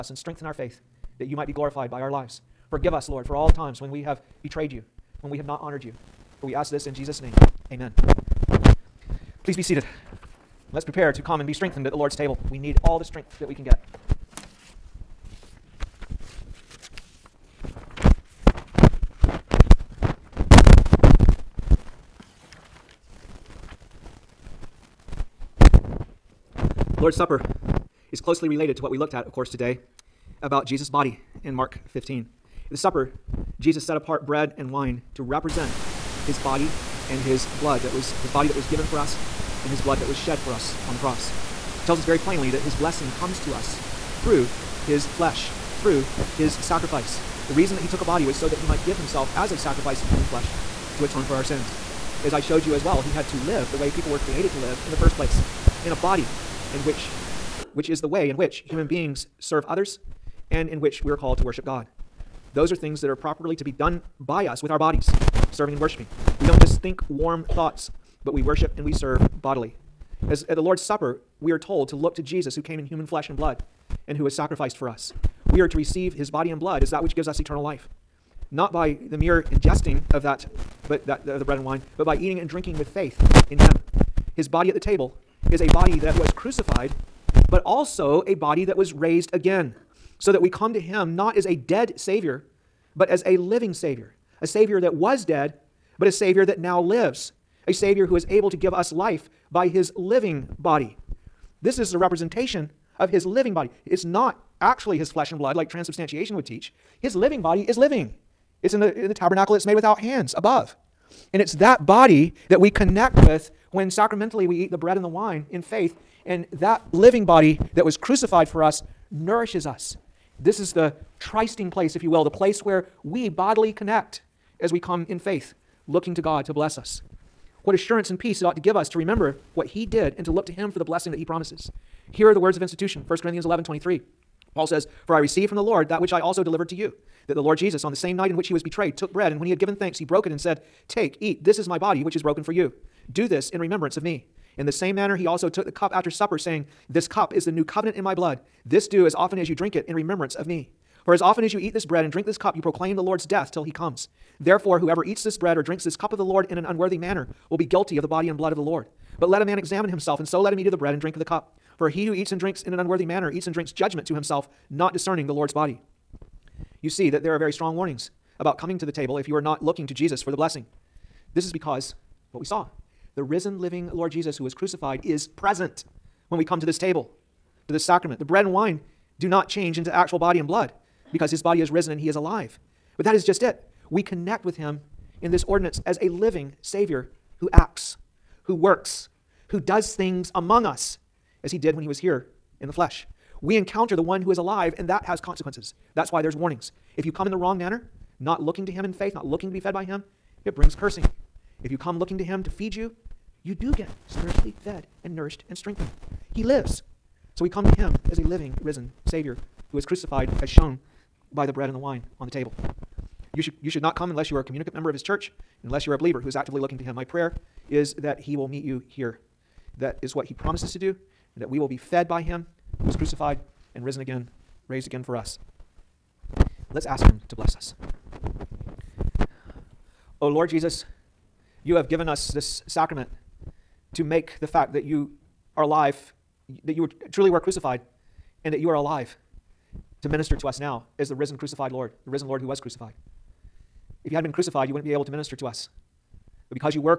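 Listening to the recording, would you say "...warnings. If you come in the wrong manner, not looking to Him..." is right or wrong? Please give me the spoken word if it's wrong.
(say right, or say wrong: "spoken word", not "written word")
right.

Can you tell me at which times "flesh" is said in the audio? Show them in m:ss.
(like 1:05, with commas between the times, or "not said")
0:45, 0:50, 1:13, 1:45, 3:12.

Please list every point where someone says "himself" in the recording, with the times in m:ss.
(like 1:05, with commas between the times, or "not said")
0:48, 2:39, 2:44.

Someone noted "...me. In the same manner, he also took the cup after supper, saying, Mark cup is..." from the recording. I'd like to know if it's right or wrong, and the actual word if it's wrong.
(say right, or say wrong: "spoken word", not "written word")
wrong: "This", not "Mark".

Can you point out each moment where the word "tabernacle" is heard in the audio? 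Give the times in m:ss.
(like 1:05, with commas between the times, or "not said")
1:49.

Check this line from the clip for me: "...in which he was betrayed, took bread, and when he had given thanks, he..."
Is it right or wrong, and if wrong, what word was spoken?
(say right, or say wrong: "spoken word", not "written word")
right.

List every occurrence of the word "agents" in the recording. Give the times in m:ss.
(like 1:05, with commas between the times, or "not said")
not said.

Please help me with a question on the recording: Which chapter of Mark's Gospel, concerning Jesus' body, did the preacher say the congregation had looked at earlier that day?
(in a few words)
Mark 15.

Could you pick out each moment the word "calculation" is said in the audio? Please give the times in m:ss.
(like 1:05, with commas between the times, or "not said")
not said.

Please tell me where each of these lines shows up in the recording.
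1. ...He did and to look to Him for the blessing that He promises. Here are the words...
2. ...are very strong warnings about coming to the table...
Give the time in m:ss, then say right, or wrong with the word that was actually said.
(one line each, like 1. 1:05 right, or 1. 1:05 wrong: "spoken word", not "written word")
1. 2:09 right
2. 2:47 right.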